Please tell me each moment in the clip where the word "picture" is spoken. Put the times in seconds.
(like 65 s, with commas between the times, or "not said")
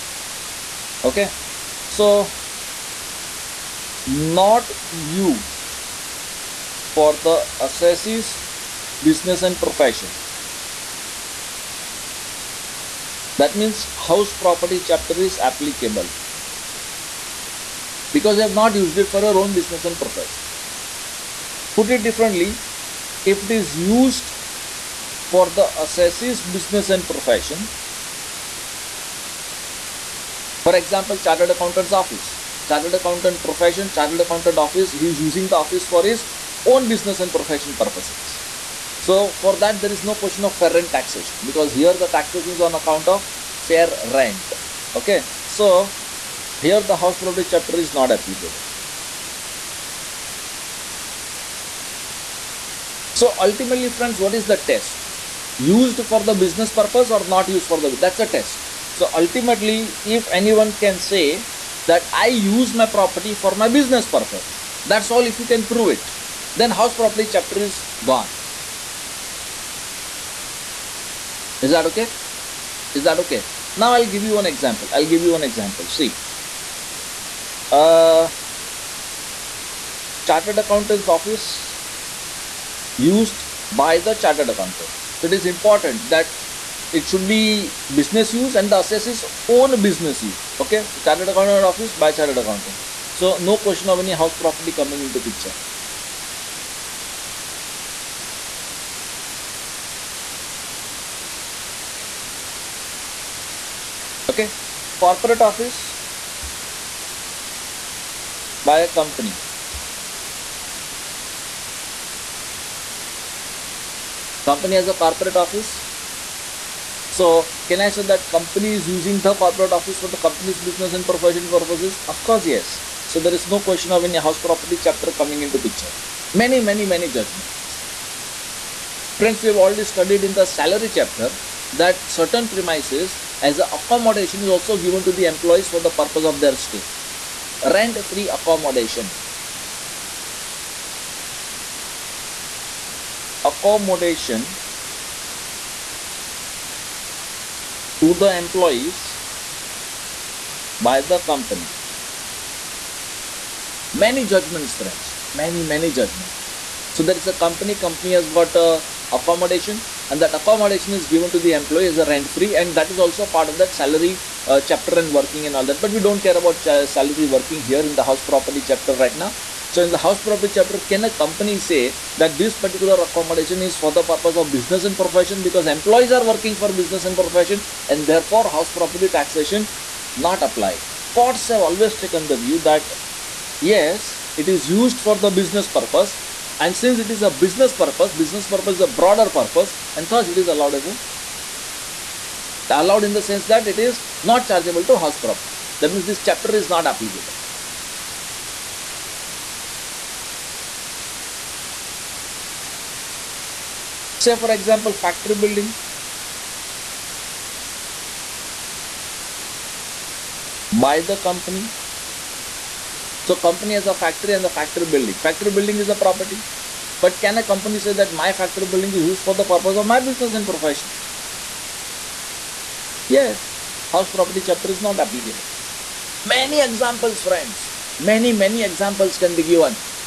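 95 s, 125 s.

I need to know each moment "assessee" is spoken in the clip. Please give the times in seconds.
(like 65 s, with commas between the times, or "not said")
7 s, 25 s, 88 s.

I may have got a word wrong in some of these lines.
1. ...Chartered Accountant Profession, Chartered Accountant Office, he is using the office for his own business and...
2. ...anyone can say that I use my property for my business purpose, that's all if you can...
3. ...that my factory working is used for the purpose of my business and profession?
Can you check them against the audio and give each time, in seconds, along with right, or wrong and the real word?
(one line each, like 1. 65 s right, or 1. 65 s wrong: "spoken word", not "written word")
1. 32 s right
2. 60 s right
3. 217 s wrong: "building", not "working".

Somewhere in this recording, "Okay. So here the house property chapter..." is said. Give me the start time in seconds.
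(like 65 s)
44 s.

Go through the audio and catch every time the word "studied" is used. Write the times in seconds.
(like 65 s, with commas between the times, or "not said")
129 s.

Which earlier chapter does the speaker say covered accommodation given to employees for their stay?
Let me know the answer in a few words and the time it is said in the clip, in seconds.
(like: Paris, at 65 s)
Salary chapter, at 130 s.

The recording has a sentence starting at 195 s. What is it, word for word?
That means this chapter is not applicable.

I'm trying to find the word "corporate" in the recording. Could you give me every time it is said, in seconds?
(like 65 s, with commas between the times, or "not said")
105 s, 115 s, 119 s.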